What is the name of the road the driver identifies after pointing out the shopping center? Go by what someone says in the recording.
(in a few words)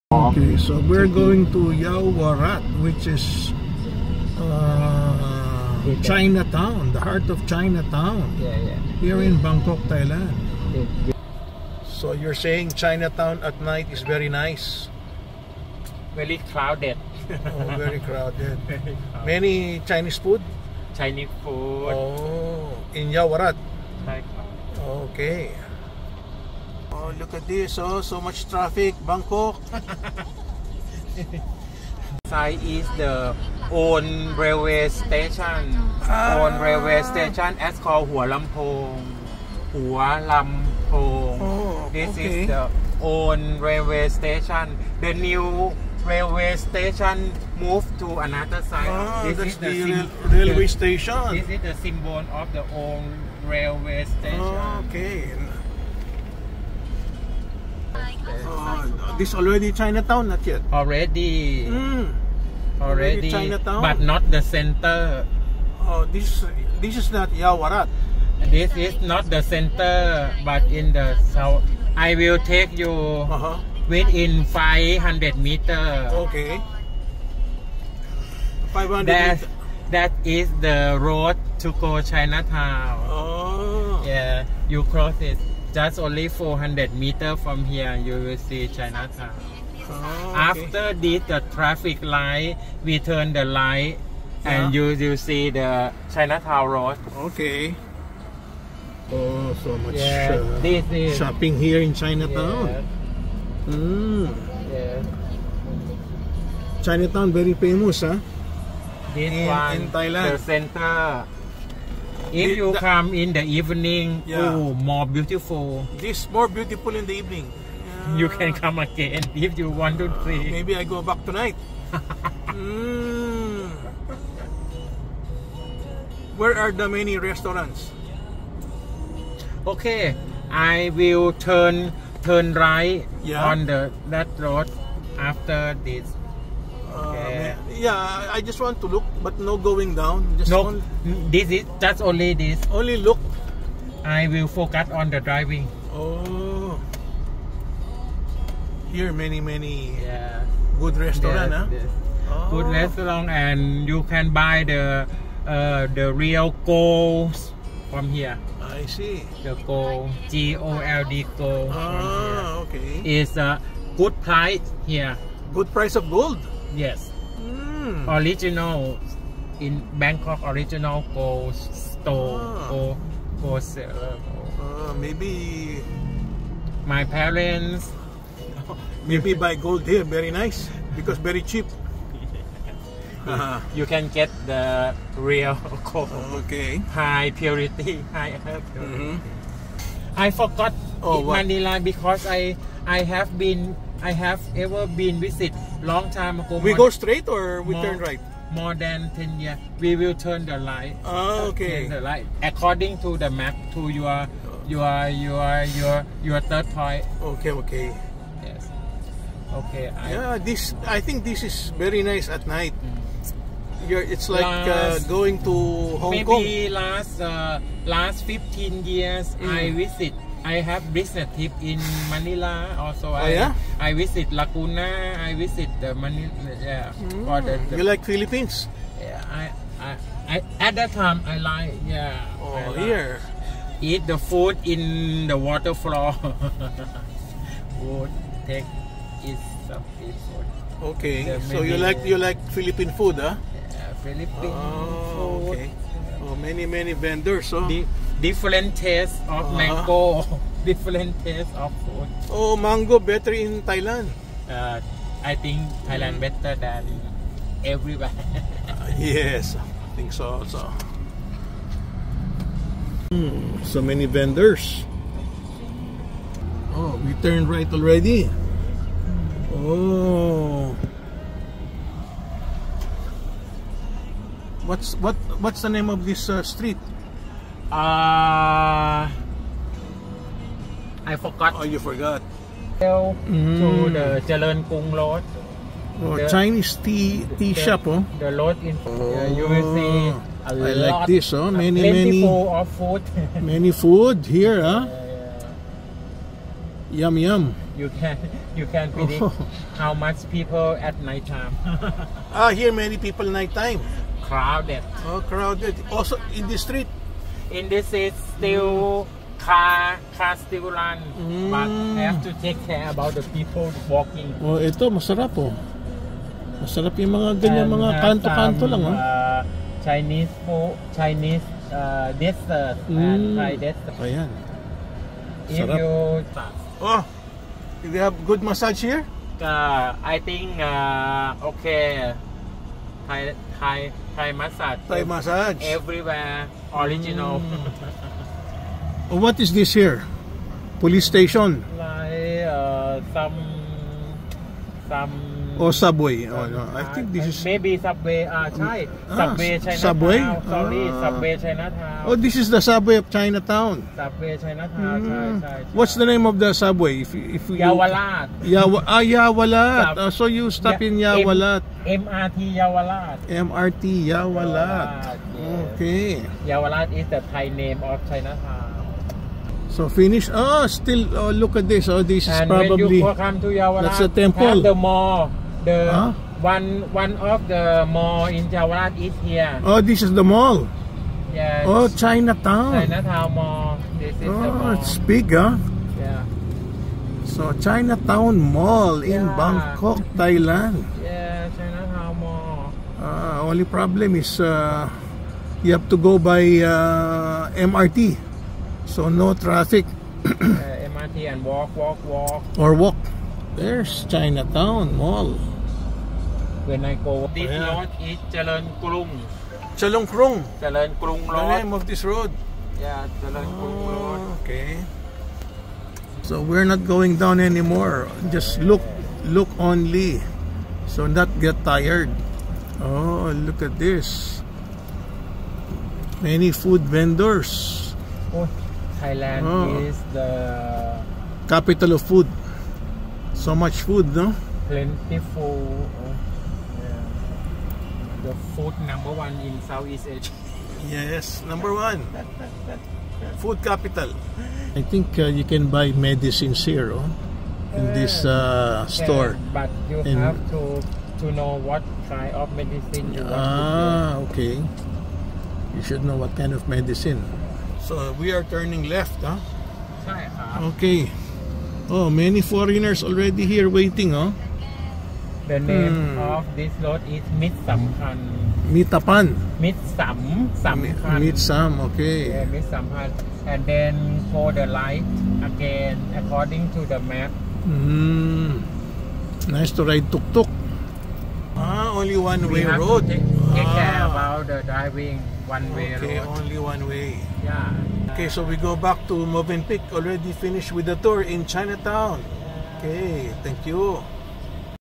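Charoen Krung Road.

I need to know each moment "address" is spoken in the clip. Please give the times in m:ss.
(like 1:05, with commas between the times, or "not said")
not said.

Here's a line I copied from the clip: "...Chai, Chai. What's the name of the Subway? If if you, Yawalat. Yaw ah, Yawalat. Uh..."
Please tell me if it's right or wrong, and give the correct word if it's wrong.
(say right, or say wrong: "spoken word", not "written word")
right.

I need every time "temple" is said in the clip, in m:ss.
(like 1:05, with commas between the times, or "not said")
6:14.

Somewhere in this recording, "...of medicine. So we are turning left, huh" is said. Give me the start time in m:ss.
7:36.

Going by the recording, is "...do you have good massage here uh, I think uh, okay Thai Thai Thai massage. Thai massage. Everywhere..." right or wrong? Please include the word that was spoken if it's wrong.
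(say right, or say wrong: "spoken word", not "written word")
right.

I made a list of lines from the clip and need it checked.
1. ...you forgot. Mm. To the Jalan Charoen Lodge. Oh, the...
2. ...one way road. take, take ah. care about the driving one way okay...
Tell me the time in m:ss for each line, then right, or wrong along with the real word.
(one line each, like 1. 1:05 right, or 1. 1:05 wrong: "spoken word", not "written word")
1. 4:41 wrong: "Kung", not "Charoen"
2. 8:02 right.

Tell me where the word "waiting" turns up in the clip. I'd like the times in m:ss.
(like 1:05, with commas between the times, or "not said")
7:43.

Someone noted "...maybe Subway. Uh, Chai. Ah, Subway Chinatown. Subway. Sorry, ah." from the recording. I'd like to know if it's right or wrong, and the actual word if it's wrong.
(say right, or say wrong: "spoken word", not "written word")
right.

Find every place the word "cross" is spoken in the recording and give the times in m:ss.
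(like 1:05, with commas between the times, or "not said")
1:24.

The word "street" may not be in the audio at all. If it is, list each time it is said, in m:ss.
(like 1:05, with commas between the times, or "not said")
4:36, 5:06.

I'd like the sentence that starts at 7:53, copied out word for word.
And then for the light again according to the map.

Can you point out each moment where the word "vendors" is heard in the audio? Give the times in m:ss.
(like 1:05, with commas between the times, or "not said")
4:06, 4:24, 7:06.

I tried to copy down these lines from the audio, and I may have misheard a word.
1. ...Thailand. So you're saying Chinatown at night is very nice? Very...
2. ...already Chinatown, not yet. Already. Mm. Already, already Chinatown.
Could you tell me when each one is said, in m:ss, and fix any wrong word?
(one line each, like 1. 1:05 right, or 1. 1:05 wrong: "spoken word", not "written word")
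1. 0:09 right
2. 0:59 right.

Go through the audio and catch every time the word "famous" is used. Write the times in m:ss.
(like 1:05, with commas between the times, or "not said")
1:47.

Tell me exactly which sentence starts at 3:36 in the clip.
Maybe last uh, last 15 years mm.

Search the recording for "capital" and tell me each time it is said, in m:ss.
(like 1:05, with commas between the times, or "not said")
7:11, 7:23.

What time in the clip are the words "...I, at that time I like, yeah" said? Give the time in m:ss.
3:50.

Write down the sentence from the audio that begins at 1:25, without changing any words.
Just only 400 meters from here, you will see Chinatown.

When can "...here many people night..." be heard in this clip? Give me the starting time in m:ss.
5:02.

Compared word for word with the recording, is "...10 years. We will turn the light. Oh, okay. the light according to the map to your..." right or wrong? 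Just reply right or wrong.
right.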